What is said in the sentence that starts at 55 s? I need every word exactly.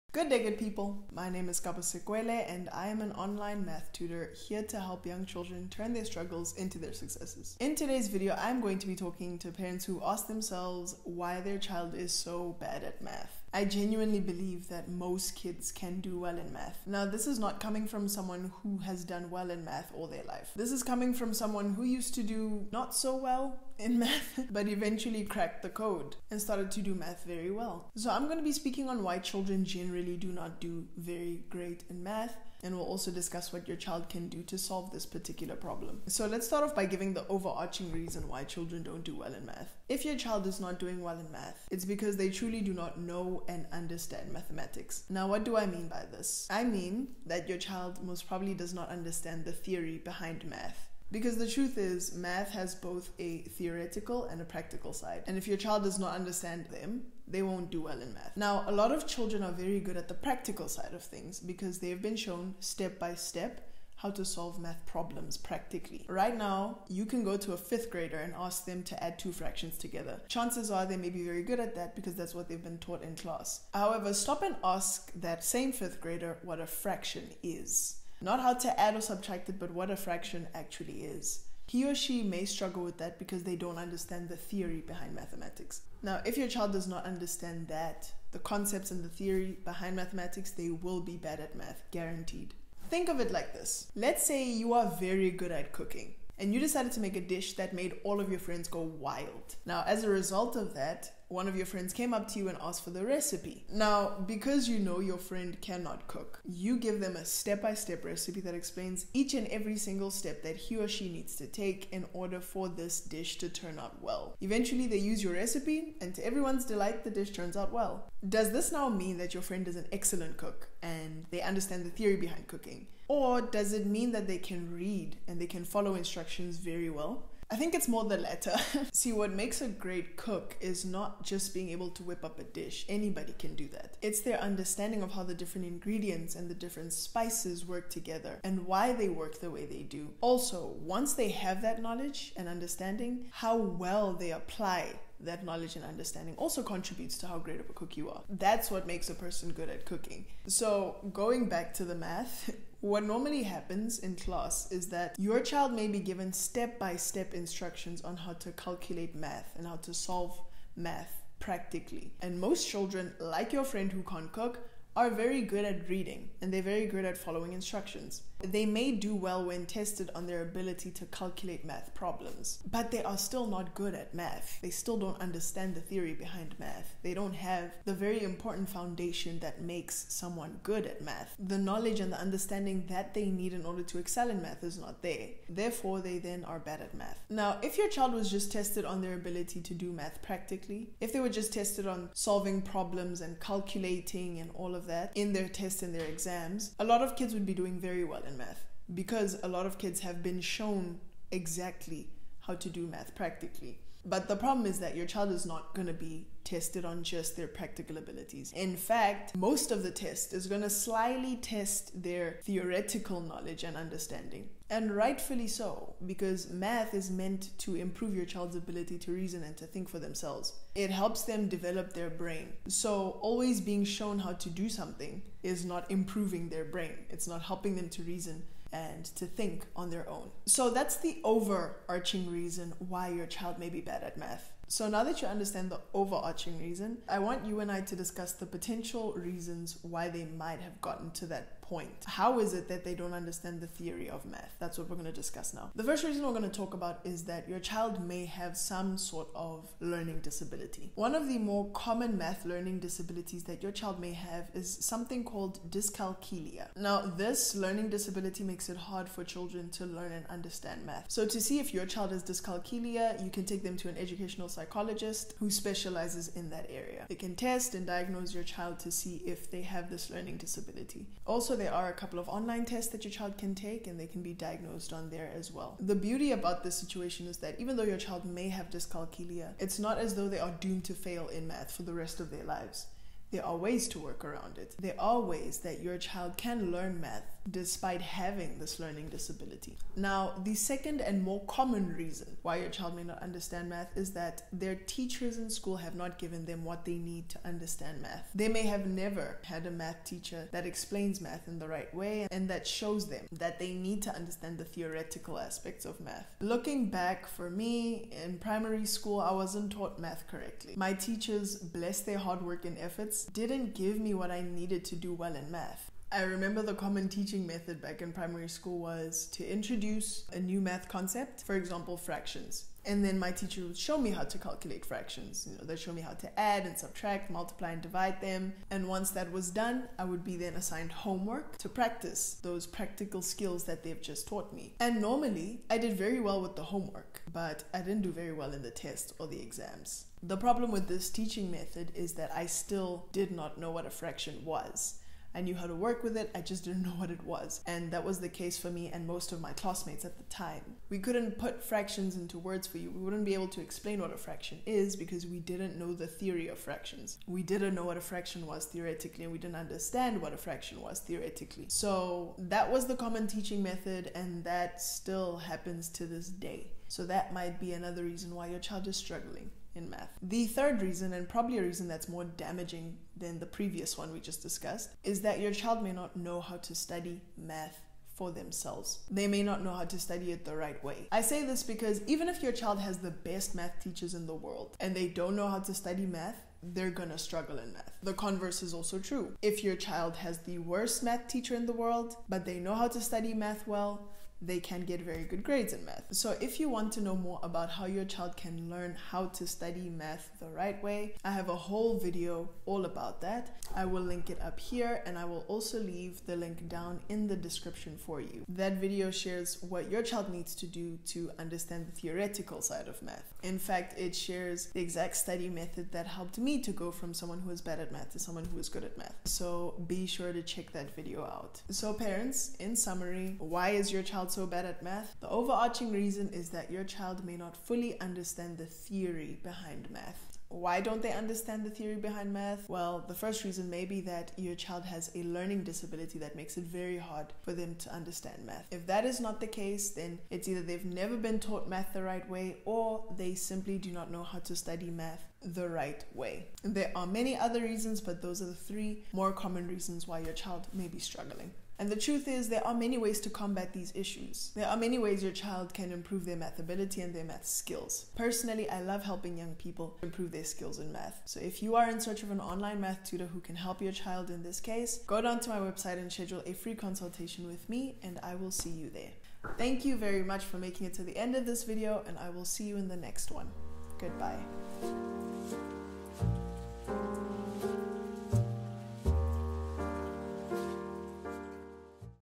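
And if your child does not understand them, they won't do well in math.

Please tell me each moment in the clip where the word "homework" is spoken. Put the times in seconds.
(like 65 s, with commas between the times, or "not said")
330 s, 336 s.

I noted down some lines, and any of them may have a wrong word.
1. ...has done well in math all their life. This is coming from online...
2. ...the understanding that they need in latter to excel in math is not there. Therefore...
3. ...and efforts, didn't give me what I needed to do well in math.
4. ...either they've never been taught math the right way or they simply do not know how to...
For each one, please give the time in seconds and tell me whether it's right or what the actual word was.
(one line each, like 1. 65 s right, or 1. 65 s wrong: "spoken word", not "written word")
1. 18 s wrong: "someone", not "online"
2. 182 s wrong: "order", not "latter"
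3. 312 s right
4. 440 s right.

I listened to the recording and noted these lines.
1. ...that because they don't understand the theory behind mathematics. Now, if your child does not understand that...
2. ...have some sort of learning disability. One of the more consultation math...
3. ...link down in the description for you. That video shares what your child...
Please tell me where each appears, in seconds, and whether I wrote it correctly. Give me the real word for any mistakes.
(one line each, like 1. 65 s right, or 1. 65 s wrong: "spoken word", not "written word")
1. 82 s right
2. 248 s wrong: "common", not "consultation"
3. 406 s right.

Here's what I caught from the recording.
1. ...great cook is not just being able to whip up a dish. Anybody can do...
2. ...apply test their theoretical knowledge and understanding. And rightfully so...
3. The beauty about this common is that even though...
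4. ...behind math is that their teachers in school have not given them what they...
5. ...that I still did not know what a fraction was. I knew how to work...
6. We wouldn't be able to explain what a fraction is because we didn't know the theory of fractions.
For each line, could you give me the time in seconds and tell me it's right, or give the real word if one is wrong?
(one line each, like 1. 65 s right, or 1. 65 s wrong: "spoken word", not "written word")
1. 129 s right
2. 210 s wrong: "slyly", not "apply"
3. 275 s wrong: "situation", not "common"
4. 293 s wrong: "understand", not "behind"
5. 342 s right
6. 352 s right.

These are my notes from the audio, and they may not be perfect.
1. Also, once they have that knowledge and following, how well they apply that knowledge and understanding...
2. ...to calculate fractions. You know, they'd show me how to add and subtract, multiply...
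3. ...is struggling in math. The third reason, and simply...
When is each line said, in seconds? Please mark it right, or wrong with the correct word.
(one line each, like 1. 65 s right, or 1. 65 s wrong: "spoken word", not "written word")
1. 140 s wrong: "understanding", not "following"
2. 324 s right
3. 368 s wrong: "probably", not "simply".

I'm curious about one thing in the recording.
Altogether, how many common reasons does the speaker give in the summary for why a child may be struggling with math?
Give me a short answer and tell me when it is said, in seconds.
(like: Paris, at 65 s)
3, at 448 s.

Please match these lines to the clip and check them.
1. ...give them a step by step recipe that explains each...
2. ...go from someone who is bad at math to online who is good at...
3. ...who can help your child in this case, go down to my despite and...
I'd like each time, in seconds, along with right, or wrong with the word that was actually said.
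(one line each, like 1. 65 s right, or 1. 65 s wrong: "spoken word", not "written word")
1. 106 s right
2. 416 s wrong: "someone", not "online"
3. 463 s wrong: "website", not "despite".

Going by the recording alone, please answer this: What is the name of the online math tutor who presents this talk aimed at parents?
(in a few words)
Kabo Sekoele.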